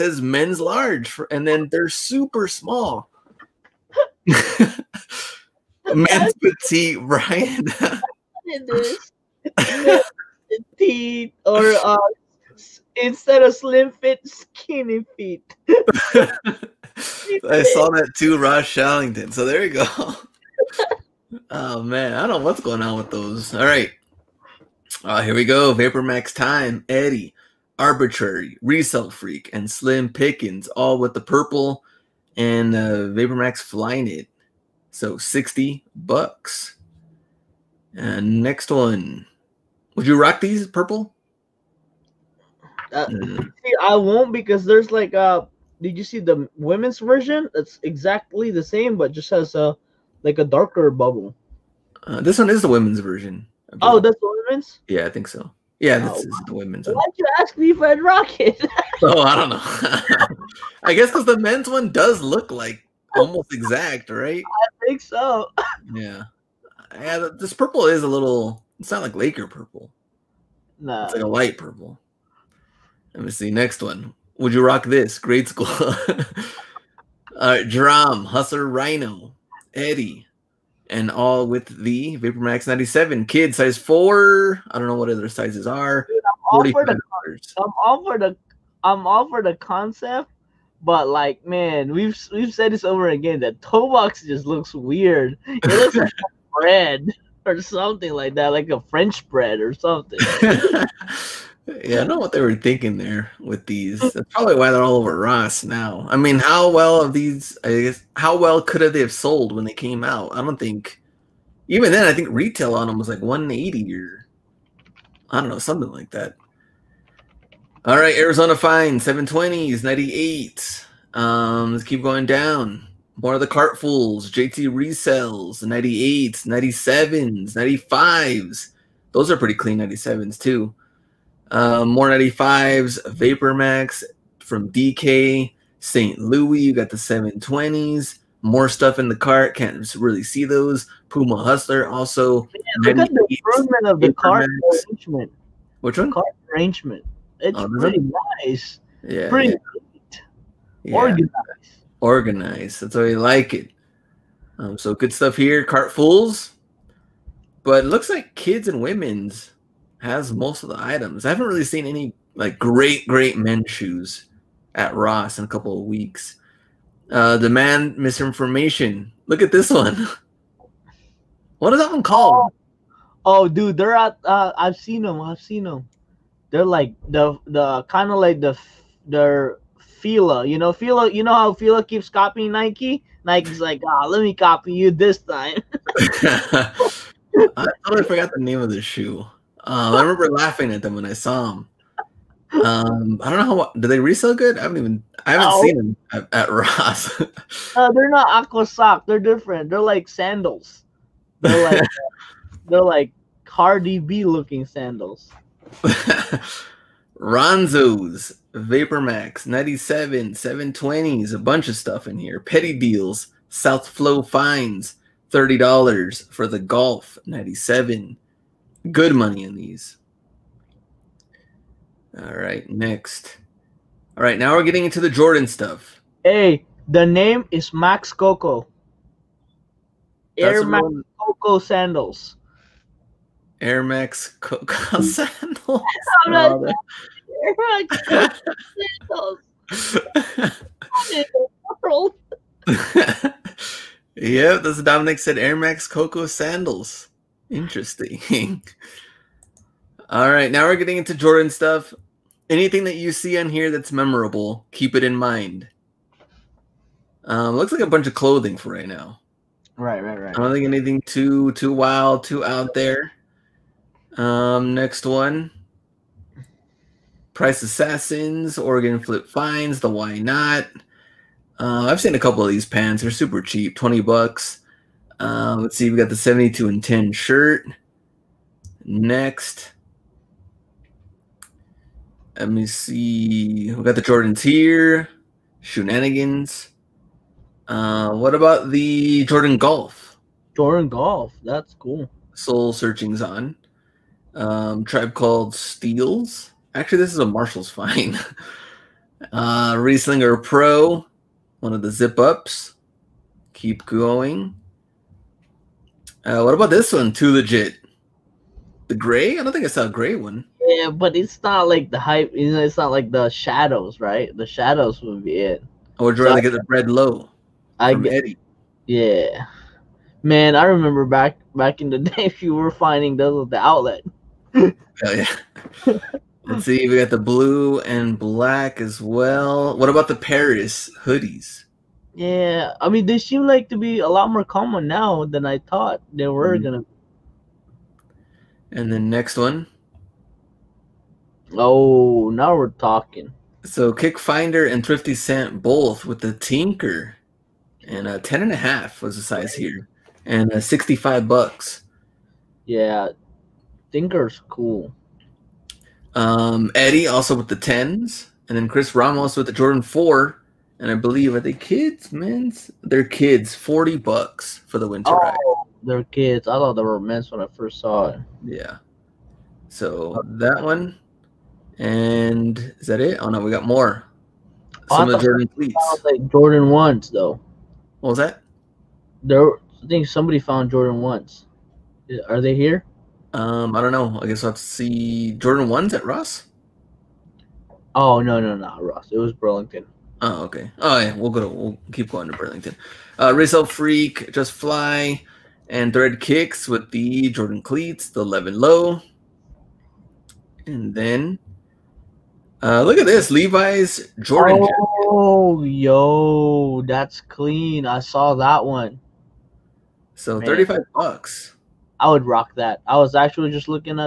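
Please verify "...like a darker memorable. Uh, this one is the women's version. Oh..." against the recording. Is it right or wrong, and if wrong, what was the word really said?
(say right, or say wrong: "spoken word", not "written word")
wrong: "bubble", not "memorable".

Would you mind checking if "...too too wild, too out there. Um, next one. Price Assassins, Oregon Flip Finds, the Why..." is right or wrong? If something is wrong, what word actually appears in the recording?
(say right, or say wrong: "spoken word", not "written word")
right.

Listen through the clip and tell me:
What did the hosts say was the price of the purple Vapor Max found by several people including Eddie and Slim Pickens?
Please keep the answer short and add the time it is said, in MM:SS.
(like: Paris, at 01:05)
$60, at 00:35.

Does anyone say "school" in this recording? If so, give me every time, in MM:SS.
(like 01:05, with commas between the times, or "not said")
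01:15.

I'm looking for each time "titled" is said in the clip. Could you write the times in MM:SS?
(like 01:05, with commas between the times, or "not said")
not said.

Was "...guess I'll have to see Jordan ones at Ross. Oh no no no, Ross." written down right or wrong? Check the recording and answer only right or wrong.
right.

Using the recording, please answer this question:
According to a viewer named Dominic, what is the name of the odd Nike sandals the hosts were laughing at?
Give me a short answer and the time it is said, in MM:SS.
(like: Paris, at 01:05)
Air Max Koko sandals, at 04:05.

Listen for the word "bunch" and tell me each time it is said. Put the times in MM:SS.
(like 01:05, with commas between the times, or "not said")
03:31, 04:17.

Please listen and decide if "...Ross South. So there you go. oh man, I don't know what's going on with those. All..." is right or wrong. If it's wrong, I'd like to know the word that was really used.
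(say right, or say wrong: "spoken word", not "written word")
wrong: "Shallington", not "South".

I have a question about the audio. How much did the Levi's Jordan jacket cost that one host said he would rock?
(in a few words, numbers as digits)
$35.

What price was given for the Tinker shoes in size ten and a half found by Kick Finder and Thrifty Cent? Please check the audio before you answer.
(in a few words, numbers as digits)
$65.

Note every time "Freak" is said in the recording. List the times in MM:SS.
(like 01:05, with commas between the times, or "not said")
00:29, 06:33.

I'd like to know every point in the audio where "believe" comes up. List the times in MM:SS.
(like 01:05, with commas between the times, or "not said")
06:00.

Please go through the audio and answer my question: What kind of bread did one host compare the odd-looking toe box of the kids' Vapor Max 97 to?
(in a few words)
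French bread.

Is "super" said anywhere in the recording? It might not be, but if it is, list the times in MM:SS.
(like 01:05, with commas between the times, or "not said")
00:01, 04:33.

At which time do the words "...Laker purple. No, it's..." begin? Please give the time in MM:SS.
01:09.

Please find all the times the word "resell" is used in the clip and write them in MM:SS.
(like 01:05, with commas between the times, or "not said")
00:28, 02:04, 03:13.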